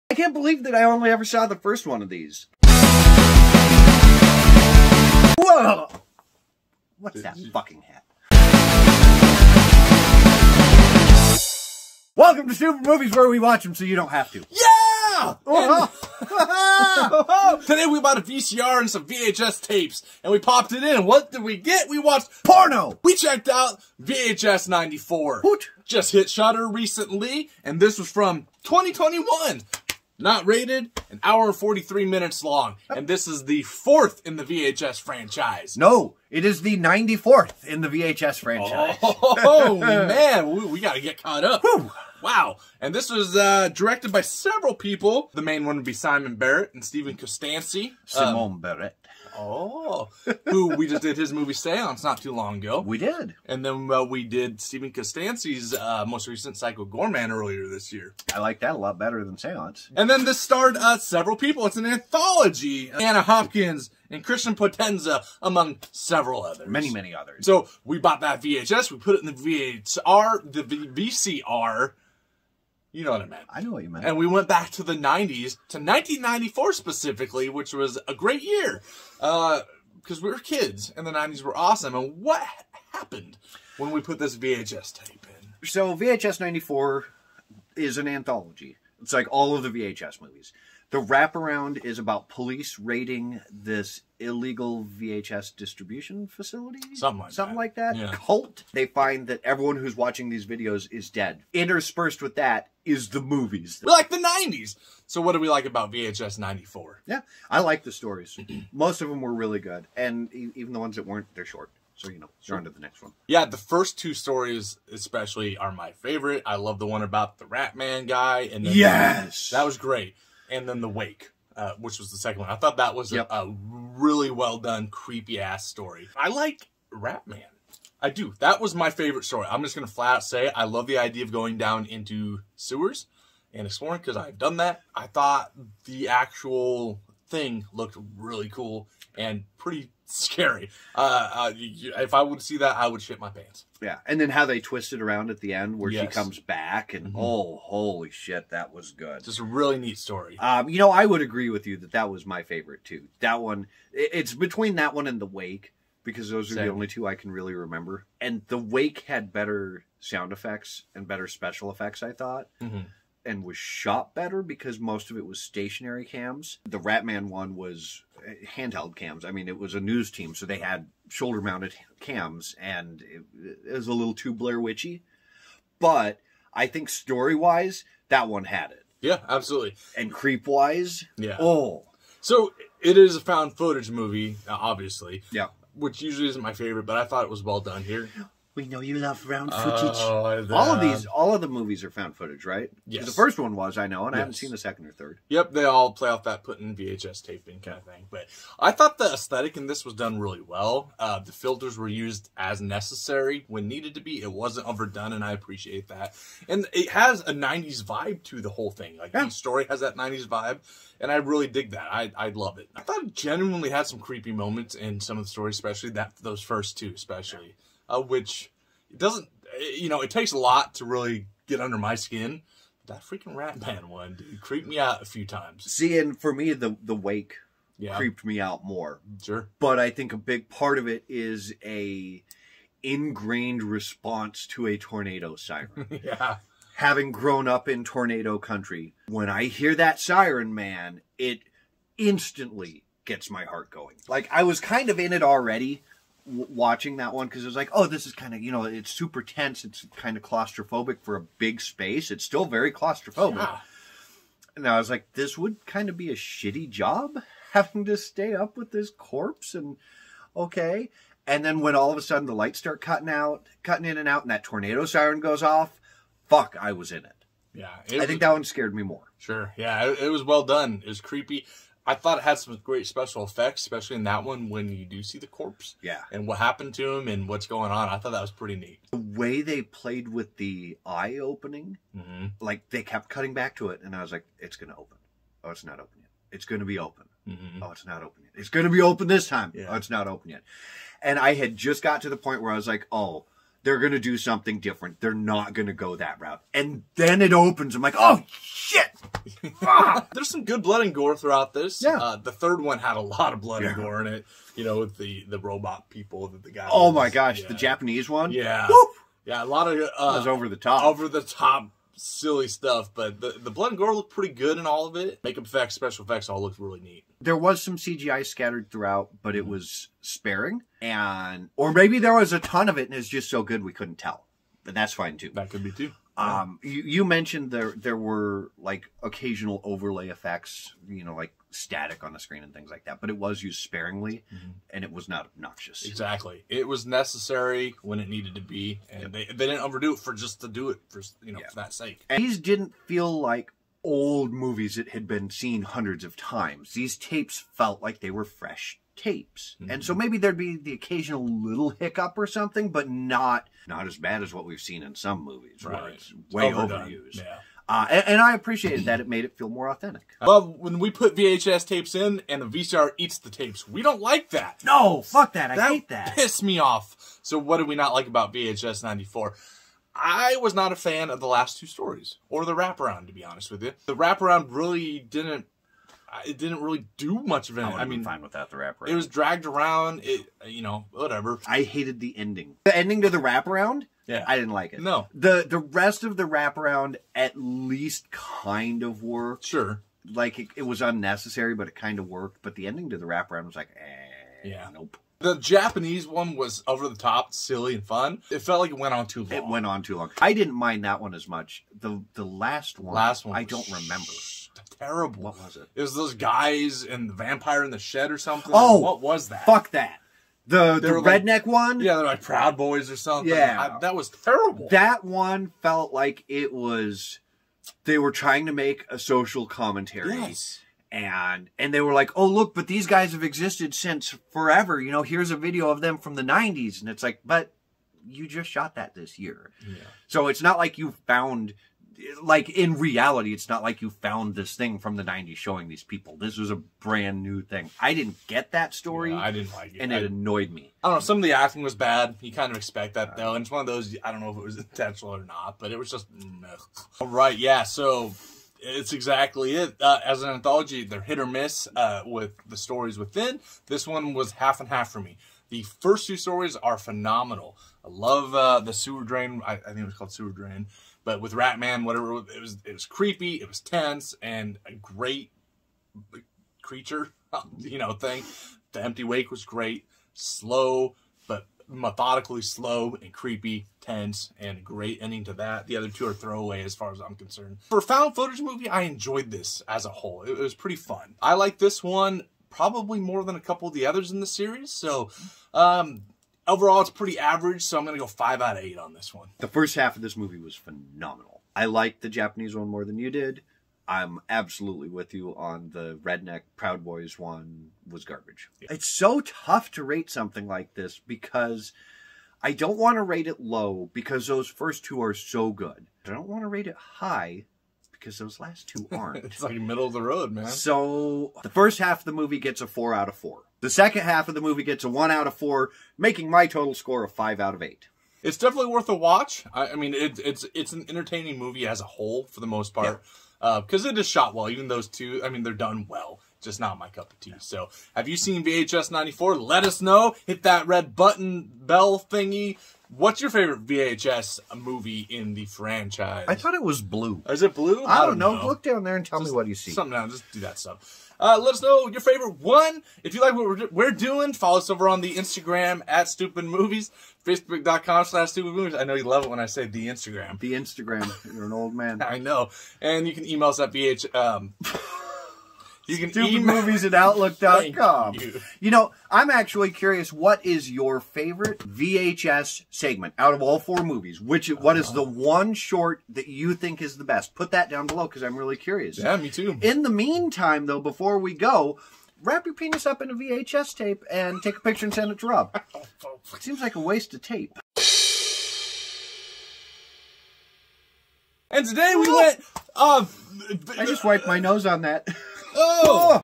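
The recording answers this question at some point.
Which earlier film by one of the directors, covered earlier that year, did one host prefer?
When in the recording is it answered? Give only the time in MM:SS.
00:56.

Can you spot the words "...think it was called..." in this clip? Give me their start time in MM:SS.
07:39.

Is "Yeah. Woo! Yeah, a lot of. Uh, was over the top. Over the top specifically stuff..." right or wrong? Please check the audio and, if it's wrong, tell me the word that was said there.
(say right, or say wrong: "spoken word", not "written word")
wrong: "silly", not "specifically".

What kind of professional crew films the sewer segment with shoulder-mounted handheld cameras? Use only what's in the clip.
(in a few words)
news team.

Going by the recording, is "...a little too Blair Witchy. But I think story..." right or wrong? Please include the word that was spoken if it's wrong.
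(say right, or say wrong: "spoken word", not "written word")
right.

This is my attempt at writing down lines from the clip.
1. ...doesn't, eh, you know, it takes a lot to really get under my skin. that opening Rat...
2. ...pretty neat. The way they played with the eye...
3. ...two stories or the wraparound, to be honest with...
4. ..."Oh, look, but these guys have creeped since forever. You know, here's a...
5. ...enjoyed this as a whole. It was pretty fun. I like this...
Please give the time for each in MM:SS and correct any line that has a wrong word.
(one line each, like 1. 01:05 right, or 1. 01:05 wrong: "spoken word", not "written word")
1. 03:38 wrong: "freaking", not "opening"
2. 04:38 right
3. 06:11 right
4. 07:02 wrong: "existed", not "creeped"
5. 07:58 right.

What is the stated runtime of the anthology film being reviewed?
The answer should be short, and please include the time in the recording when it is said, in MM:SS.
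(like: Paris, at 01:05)
1 hour 43 minutes, at 00:31.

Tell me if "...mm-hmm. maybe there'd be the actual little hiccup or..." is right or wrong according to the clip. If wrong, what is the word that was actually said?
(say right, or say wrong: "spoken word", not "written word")
wrong: "occasional", not "actual".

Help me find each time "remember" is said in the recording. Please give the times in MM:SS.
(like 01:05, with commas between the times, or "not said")
02:37, 06:43.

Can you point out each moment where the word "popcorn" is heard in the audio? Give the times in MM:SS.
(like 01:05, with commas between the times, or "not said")
not said.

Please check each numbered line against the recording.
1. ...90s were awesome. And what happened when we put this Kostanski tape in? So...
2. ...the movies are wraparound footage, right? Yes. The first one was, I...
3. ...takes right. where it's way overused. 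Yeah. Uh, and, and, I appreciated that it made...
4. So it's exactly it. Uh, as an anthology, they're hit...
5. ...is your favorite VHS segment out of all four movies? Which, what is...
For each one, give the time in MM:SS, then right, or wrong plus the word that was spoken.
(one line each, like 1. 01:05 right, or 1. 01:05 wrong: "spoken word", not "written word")
1. 01:21 wrong: "VHS", not "Kostanski"
2. 03:11 wrong: "found", not "wraparound"
3. 05:55 wrong: "movies", not "takes"
4. 07:27 right
5. 09:20 right.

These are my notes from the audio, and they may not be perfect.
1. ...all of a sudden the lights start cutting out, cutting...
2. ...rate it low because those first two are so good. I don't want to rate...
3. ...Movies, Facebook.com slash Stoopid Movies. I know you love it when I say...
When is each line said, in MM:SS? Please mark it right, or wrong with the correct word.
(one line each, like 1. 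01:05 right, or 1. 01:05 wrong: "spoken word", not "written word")
1. 04:21 right
2. 08:23 right
3. 09:06 right.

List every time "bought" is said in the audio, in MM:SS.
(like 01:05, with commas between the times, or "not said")
00:17, 01:07.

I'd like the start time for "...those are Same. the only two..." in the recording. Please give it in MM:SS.
02:36.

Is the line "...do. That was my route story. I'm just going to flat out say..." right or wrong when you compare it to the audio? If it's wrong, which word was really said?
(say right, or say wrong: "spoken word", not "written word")
wrong: "favorite", not "route".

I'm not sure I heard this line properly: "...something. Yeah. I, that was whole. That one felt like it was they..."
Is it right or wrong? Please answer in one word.
wrong.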